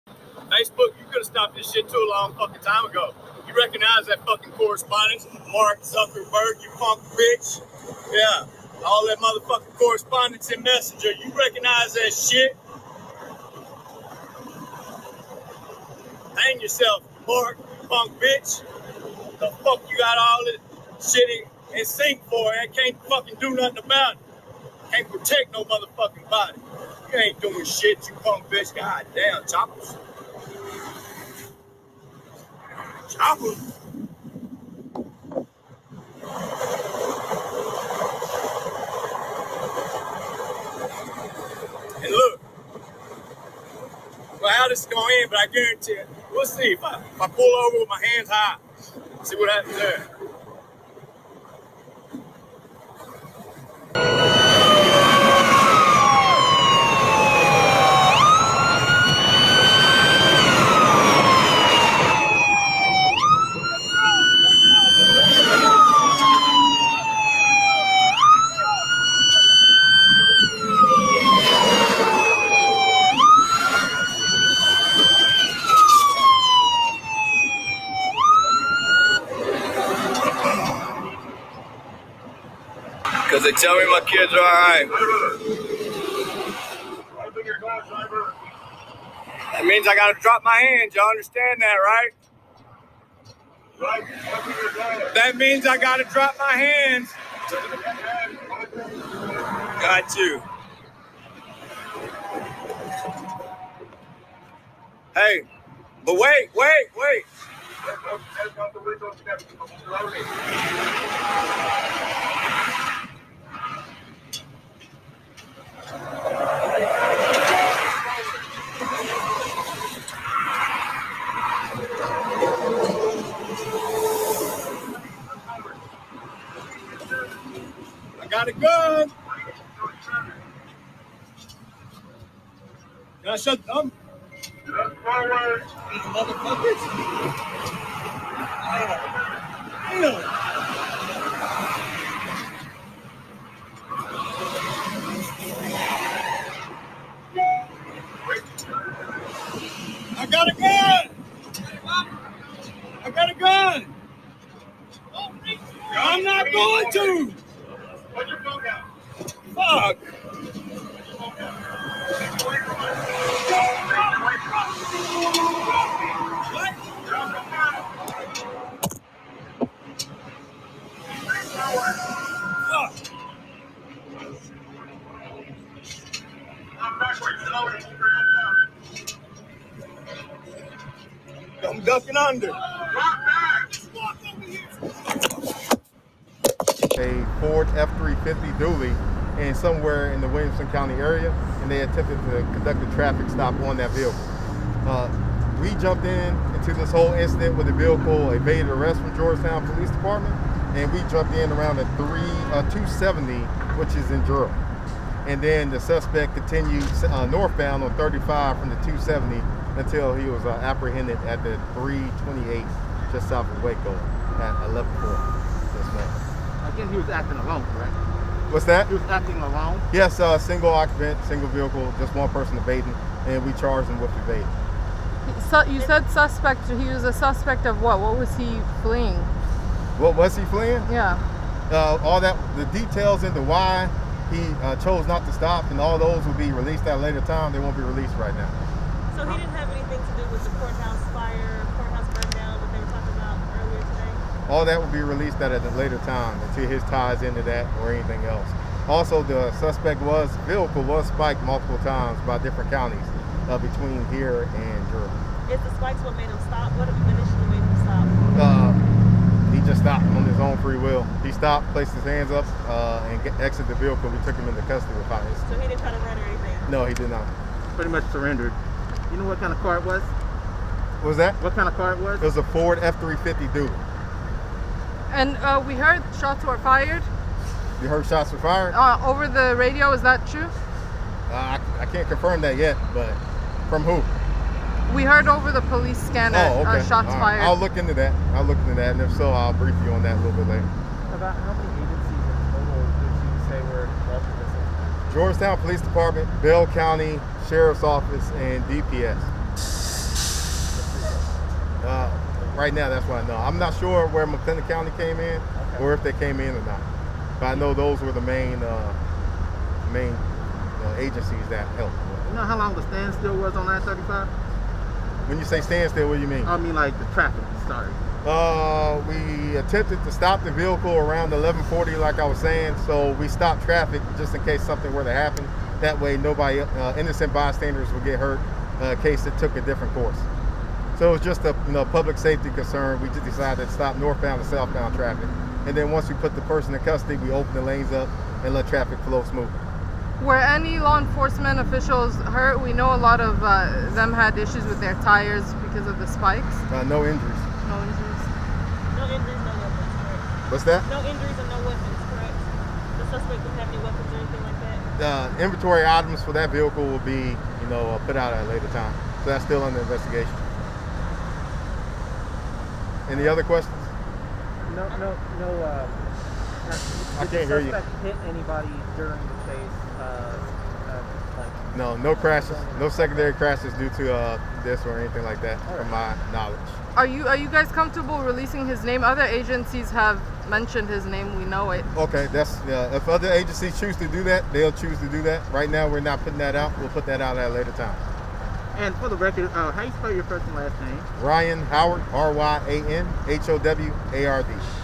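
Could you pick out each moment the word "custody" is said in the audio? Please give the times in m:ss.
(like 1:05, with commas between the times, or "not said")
4:24, 5:36.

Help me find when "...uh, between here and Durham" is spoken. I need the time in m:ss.
4:13.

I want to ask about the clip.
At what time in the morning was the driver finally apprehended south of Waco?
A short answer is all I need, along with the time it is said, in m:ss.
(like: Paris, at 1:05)
11:04, at 3:34.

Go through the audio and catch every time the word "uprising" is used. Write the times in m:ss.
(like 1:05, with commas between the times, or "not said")
not said.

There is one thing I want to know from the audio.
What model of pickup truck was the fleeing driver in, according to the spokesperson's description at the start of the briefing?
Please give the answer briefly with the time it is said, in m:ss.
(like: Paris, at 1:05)
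Ford F-350 dually, at 3:07.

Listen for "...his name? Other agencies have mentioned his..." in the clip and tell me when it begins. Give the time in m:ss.
6:18.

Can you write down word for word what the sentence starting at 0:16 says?
Hang yourself, Mark, you punk bitch.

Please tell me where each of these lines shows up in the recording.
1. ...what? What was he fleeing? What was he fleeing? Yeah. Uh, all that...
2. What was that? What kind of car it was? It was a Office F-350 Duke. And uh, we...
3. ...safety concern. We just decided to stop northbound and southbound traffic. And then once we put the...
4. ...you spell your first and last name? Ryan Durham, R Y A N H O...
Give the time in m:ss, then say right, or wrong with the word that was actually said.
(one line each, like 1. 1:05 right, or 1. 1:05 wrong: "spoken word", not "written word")
1. 3:47 right
2. 4:31 wrong: "Ford", not "Office"
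3. 5:32 right
4. 6:29 wrong: "Howard", not "Durham".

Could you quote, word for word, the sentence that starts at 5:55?
The uh, inventory items for that vehicle will be, you know, uh, put out at a later time.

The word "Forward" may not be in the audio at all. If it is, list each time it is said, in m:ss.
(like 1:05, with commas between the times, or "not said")
2:14.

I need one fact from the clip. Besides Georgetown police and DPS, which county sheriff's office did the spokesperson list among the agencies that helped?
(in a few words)
Bell County.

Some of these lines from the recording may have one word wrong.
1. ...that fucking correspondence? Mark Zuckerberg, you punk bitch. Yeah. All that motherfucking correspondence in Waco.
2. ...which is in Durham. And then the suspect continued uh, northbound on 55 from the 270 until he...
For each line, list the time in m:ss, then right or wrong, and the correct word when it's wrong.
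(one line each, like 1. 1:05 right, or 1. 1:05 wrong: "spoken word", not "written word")
1. 0:04 wrong: "Messenger", not "Waco"
2. 3:23 wrong: "35", not "55".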